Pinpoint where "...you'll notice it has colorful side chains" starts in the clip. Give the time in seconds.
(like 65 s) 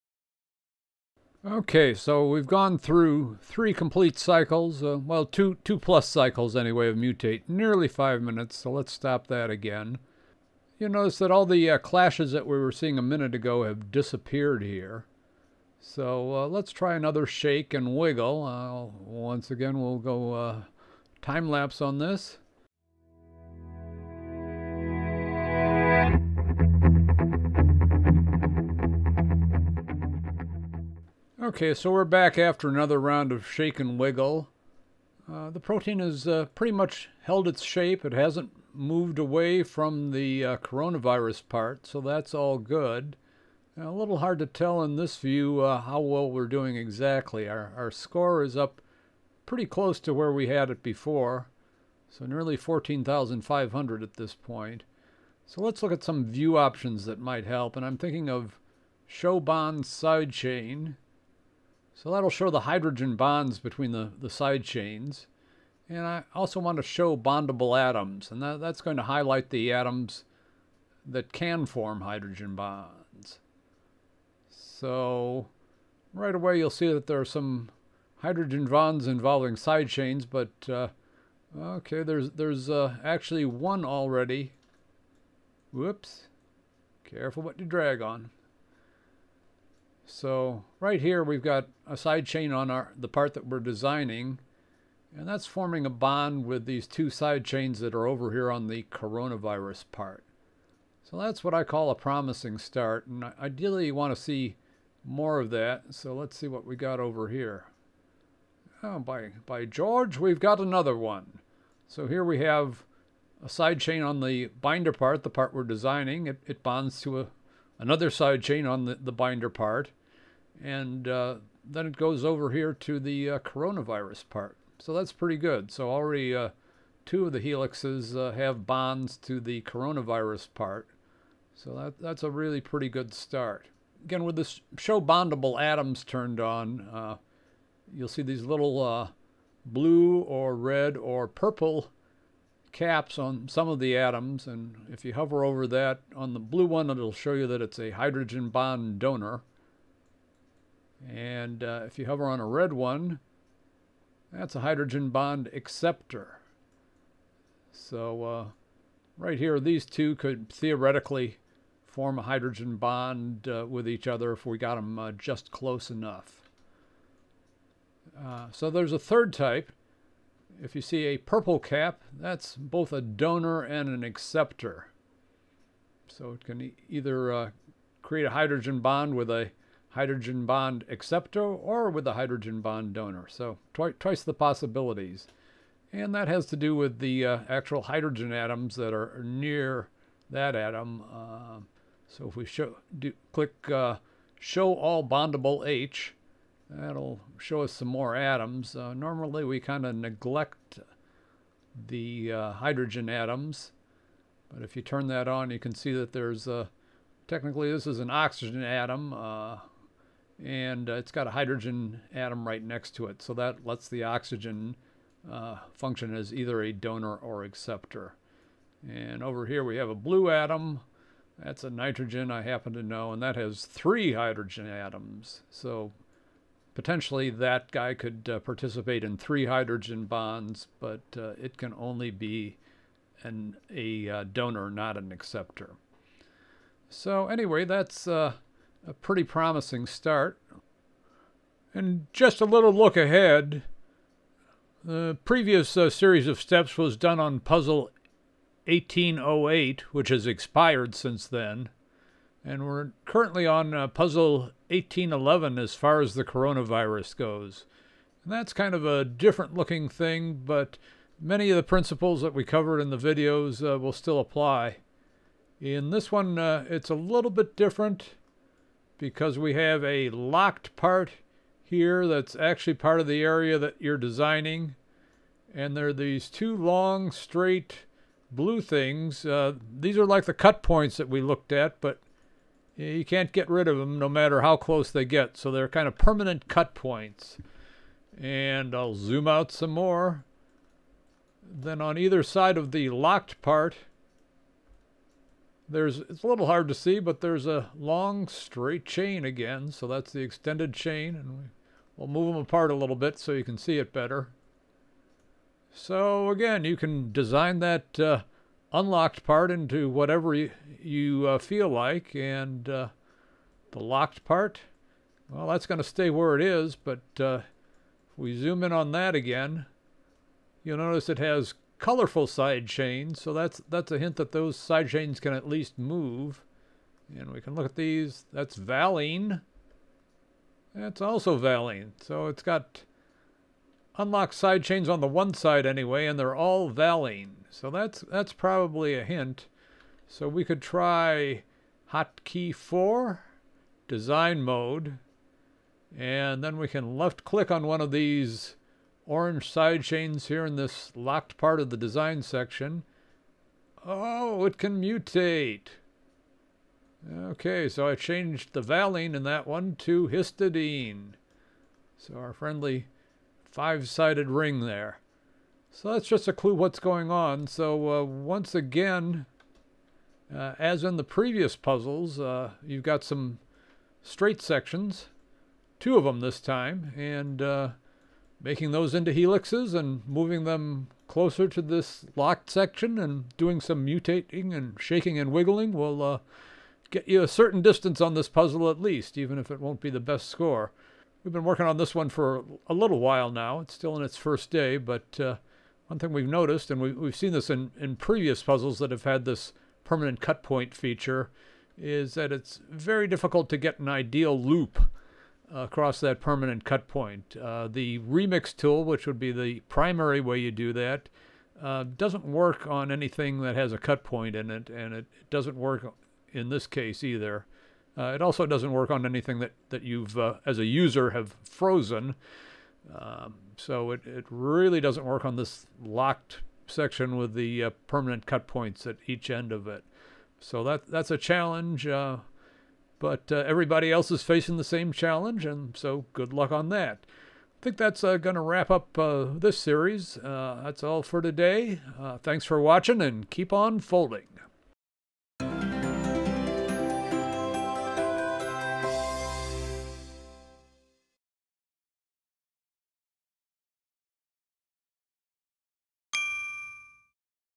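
320 s.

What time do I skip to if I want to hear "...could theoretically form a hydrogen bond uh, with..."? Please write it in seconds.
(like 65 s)
160 s.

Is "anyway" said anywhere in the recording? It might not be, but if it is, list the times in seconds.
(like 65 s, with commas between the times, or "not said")
6 s, 237 s, 335 s.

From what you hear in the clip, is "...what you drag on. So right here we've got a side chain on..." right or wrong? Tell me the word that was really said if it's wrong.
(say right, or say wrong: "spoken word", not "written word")
right.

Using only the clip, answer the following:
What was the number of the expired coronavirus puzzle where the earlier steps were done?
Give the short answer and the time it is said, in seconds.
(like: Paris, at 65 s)
1808, at 248 s.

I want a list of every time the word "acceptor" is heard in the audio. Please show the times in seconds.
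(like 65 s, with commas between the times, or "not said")
155 s, 174 s, 180 s, 217 s, 235 s.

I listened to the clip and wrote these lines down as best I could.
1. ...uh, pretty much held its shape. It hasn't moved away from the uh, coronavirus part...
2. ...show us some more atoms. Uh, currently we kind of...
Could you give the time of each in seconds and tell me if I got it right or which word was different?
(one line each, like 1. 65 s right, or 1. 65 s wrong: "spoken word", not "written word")
1. 36 s right
2. 197 s wrong: "normally", not "currently".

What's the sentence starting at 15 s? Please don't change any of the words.
So uh, let's try another shake and wiggle.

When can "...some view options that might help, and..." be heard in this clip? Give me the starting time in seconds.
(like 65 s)
56 s.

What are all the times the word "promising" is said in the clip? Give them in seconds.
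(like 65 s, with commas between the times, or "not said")
101 s, 239 s.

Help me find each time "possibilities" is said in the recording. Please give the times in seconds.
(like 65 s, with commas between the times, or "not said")
184 s.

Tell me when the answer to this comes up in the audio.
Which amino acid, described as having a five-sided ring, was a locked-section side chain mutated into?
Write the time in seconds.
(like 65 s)
360 s.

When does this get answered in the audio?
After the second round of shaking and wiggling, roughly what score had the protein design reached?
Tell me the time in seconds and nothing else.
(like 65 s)
52 s.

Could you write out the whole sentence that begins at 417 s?
Uh, it also doesn't work on anything that, that you've, uh, as a user, have frozen.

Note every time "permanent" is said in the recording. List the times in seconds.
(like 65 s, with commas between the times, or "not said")
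285 s, 399 s, 406 s, 427 s.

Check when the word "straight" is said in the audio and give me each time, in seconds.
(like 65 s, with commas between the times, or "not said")
277 s, 298 s, 374 s.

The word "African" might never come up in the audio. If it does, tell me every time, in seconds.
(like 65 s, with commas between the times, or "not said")
not said.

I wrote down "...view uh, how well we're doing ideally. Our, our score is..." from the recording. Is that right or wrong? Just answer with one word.
wrong.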